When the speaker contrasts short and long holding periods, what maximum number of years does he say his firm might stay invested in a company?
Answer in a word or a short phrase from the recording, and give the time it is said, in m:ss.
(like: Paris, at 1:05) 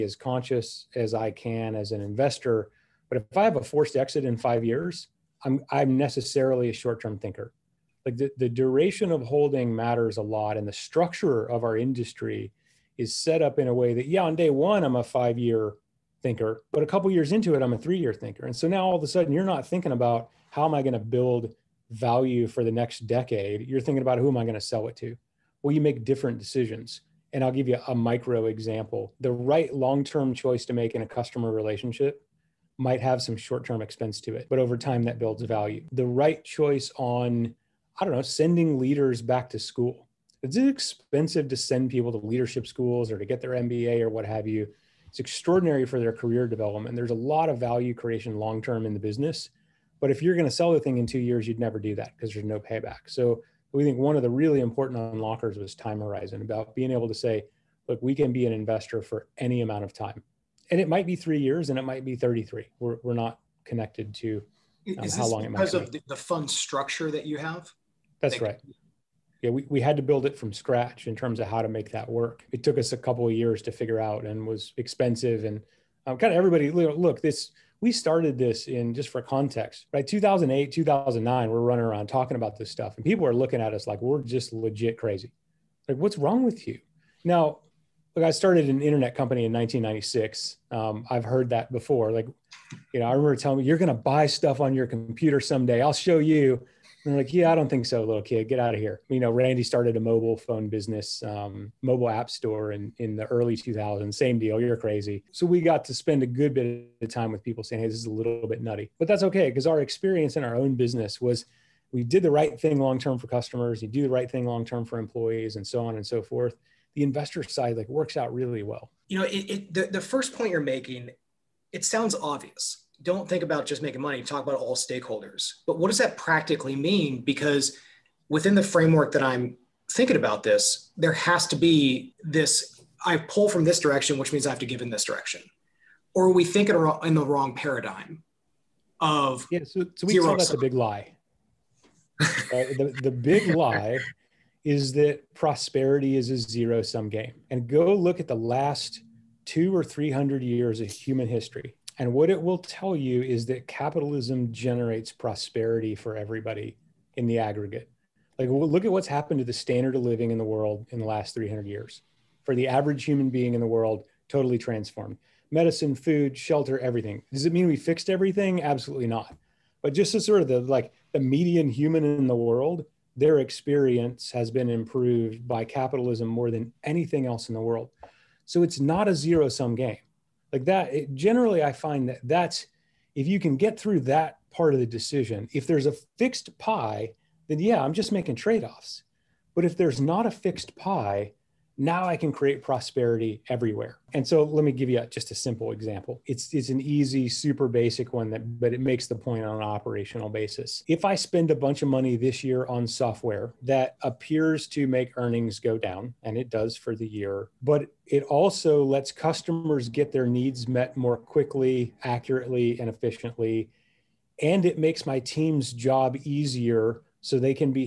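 33, at 1:02.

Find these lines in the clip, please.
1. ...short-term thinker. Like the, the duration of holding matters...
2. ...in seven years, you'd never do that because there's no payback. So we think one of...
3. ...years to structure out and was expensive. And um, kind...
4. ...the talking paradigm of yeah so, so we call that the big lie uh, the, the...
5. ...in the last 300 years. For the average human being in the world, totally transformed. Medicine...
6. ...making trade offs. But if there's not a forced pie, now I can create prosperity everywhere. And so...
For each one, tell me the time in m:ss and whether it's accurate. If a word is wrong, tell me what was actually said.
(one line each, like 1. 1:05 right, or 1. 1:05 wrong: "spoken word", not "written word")
1. 0:06 right
2. 0:50 wrong: "two", not "seven"
3. 1:13 wrong: "figure", not "structure"
4. 2:17 wrong: "wrong", not "talking"
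5. 2:40 right
6. 3:08 wrong: "fixed", not "forced".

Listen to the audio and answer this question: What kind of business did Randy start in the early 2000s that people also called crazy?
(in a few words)
mobile app store.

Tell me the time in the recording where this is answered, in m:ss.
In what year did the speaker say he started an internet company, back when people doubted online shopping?
1:29.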